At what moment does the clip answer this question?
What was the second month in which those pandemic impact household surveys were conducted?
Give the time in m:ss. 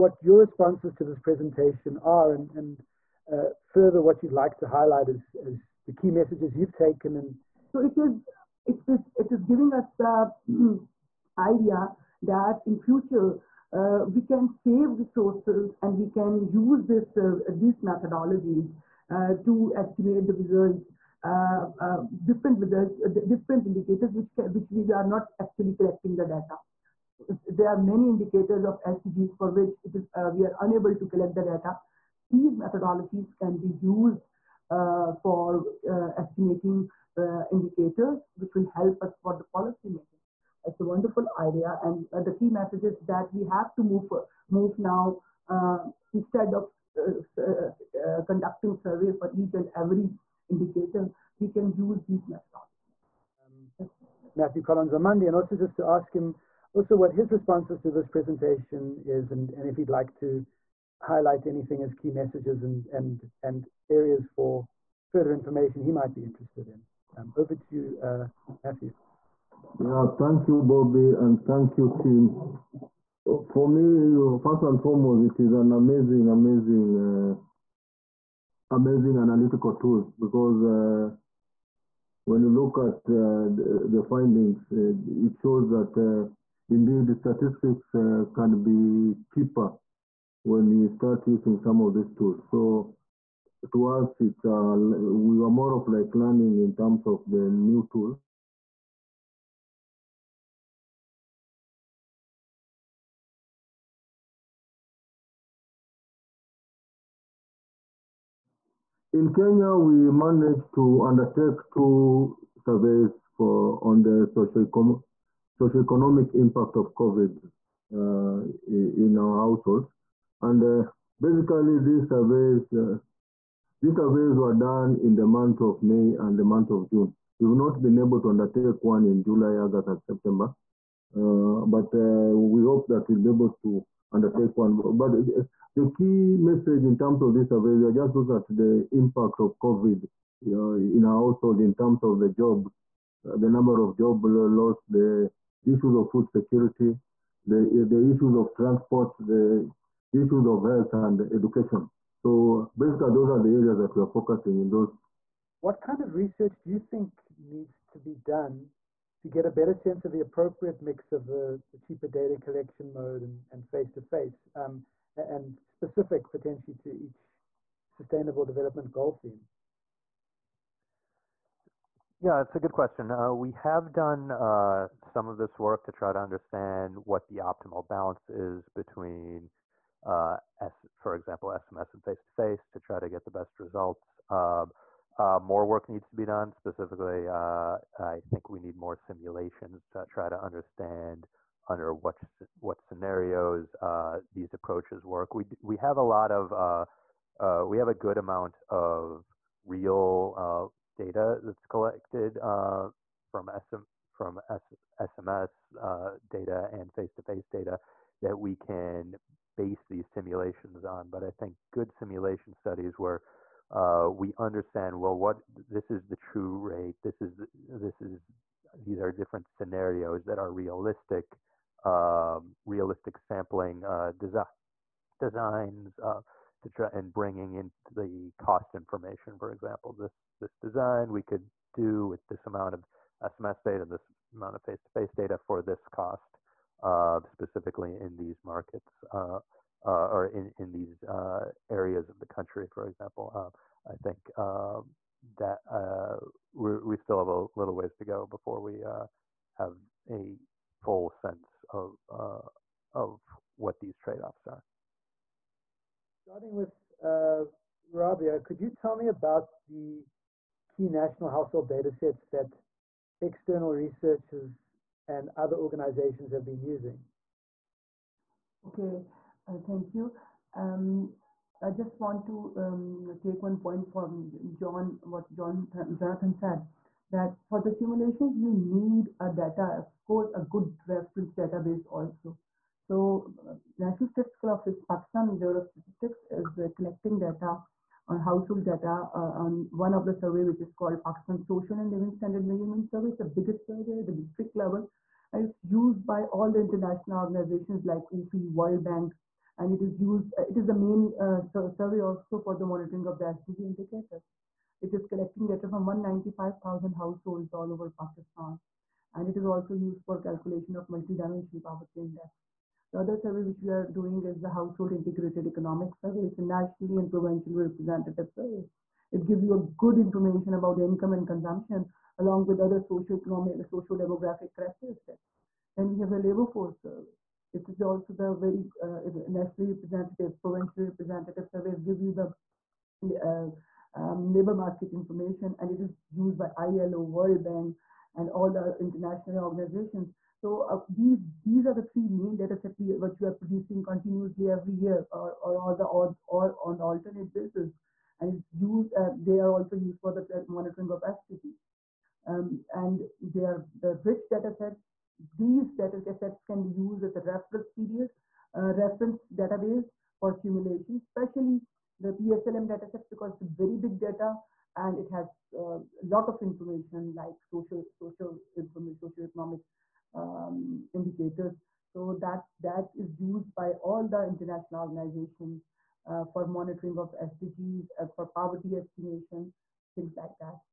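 2:06.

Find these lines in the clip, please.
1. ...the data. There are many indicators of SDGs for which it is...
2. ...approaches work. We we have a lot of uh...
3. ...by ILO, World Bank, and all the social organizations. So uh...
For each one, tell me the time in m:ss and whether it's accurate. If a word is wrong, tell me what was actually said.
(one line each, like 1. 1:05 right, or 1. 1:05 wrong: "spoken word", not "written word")
1. 0:26 right
2. 3:14 right
3. 5:36 wrong: "international", not "social".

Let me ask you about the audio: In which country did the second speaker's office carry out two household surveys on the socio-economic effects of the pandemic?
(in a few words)
Kenya.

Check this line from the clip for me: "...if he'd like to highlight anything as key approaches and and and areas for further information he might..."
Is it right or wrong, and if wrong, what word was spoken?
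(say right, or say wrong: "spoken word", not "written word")
wrong: "messages", not "approaches".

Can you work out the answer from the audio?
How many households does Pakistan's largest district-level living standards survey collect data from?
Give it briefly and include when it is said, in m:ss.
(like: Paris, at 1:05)
195,000, at 5:05.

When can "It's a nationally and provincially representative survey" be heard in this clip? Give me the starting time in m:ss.
5:16.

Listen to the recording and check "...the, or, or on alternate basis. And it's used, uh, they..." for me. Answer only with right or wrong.
right.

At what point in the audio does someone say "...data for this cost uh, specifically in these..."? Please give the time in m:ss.
3:55.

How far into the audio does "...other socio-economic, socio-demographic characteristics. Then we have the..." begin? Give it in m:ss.
5:22.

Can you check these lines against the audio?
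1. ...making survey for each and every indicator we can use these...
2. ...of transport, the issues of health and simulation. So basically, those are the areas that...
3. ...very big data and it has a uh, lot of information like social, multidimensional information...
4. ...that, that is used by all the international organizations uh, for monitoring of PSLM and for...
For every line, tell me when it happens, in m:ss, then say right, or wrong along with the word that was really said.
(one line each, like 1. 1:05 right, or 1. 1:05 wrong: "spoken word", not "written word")
1. 0:48 wrong: "conducting", not "making"
2. 2:28 wrong: "education", not "simulation"
3. 6:03 wrong: "social", not "multidimensional"
4. 6:12 wrong: "SDGs", not "PSLM".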